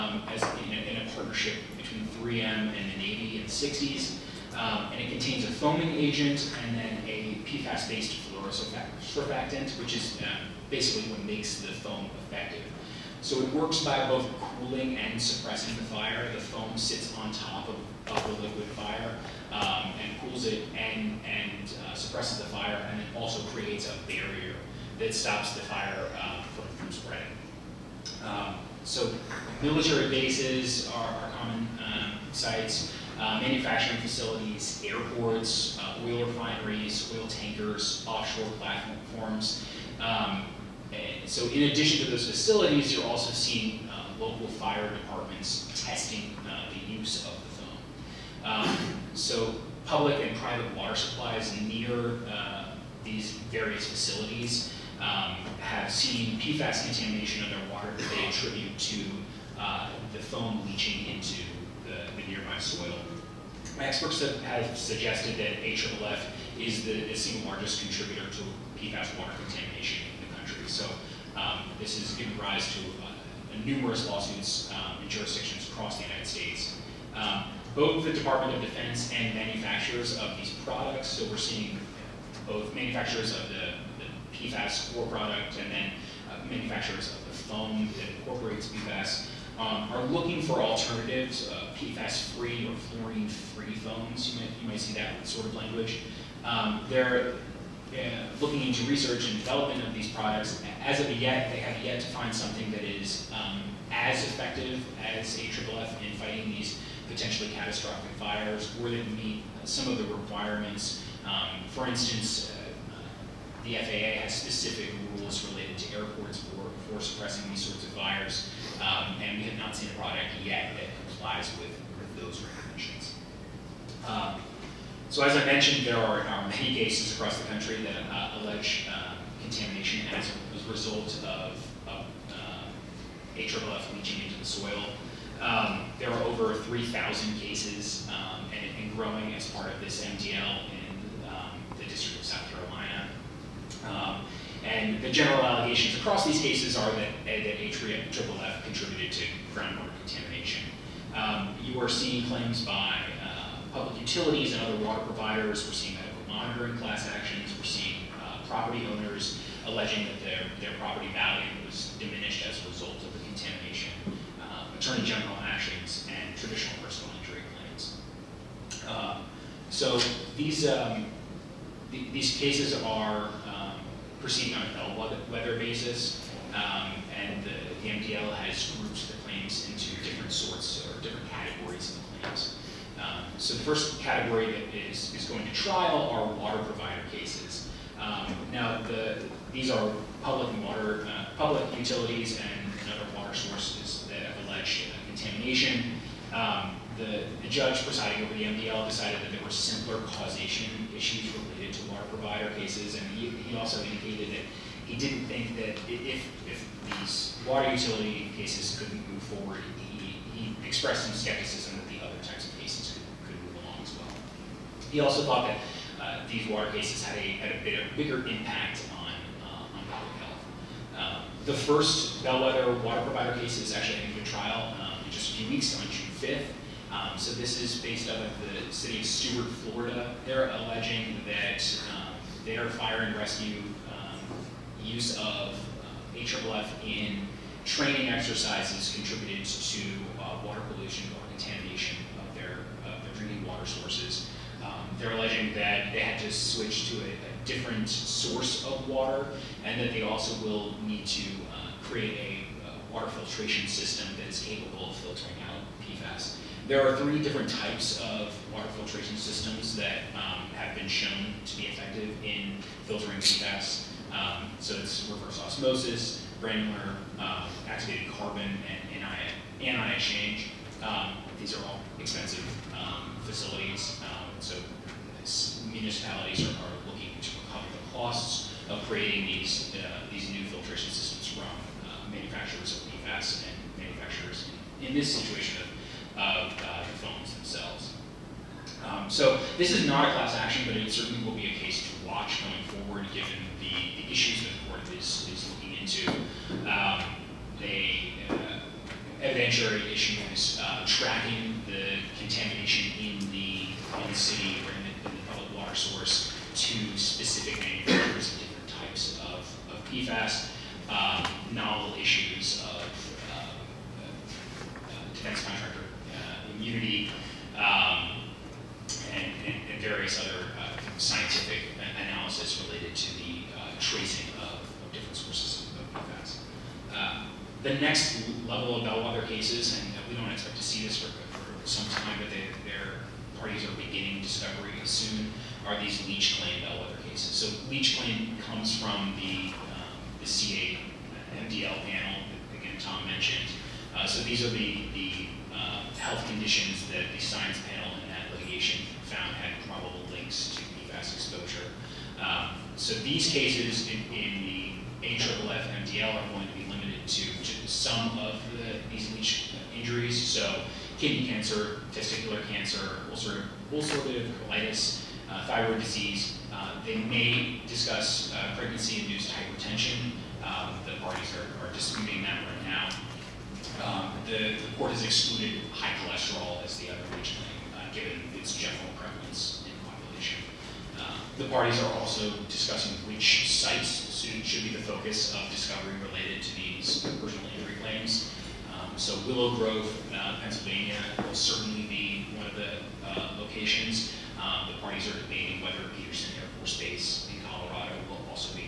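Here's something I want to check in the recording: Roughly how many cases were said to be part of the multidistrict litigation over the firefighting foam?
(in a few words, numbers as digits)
Over 3,000.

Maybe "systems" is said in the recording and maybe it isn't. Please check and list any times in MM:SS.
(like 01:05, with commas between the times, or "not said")
04:13, 04:19, 04:40.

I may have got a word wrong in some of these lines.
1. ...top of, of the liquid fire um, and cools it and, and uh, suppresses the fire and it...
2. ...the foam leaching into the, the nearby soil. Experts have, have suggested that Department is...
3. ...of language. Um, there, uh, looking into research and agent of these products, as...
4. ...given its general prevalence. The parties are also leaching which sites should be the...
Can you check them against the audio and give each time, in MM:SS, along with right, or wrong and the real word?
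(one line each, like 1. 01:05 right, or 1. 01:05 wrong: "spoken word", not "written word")
1. 00:17 right
2. 01:00 wrong: "AFFF", not "Department"
3. 01:35 wrong: "development", not "agent"
4. 06:17 wrong: "discussing", not "leaching".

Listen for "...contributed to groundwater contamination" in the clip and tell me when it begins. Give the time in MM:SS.
02:28.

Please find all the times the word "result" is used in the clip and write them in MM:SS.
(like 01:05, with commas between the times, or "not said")
02:10, 02:42.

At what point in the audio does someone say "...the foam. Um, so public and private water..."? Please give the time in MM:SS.
00:47.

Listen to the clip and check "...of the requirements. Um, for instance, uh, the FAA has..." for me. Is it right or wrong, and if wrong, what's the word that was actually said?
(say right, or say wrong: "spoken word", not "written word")
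right.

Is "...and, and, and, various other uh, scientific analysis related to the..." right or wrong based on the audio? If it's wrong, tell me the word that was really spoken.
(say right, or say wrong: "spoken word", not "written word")
right.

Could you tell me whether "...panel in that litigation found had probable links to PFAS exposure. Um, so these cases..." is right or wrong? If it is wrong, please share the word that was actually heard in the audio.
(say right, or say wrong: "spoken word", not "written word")
right.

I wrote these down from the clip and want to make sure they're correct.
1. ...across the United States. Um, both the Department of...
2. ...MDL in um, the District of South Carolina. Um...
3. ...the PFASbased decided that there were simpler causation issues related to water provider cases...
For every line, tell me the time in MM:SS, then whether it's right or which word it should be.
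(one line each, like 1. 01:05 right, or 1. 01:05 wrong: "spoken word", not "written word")
1. 01:15 right
2. 02:20 right
3. 03:18 wrong: "MDL", not "PFASbased".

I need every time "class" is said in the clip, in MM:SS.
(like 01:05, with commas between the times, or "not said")
02:36, 04:50.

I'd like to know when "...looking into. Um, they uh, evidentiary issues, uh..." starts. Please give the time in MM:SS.
04:55.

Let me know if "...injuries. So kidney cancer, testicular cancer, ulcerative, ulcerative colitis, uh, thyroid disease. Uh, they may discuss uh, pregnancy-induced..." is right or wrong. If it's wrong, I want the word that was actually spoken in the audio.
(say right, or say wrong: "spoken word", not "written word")
right.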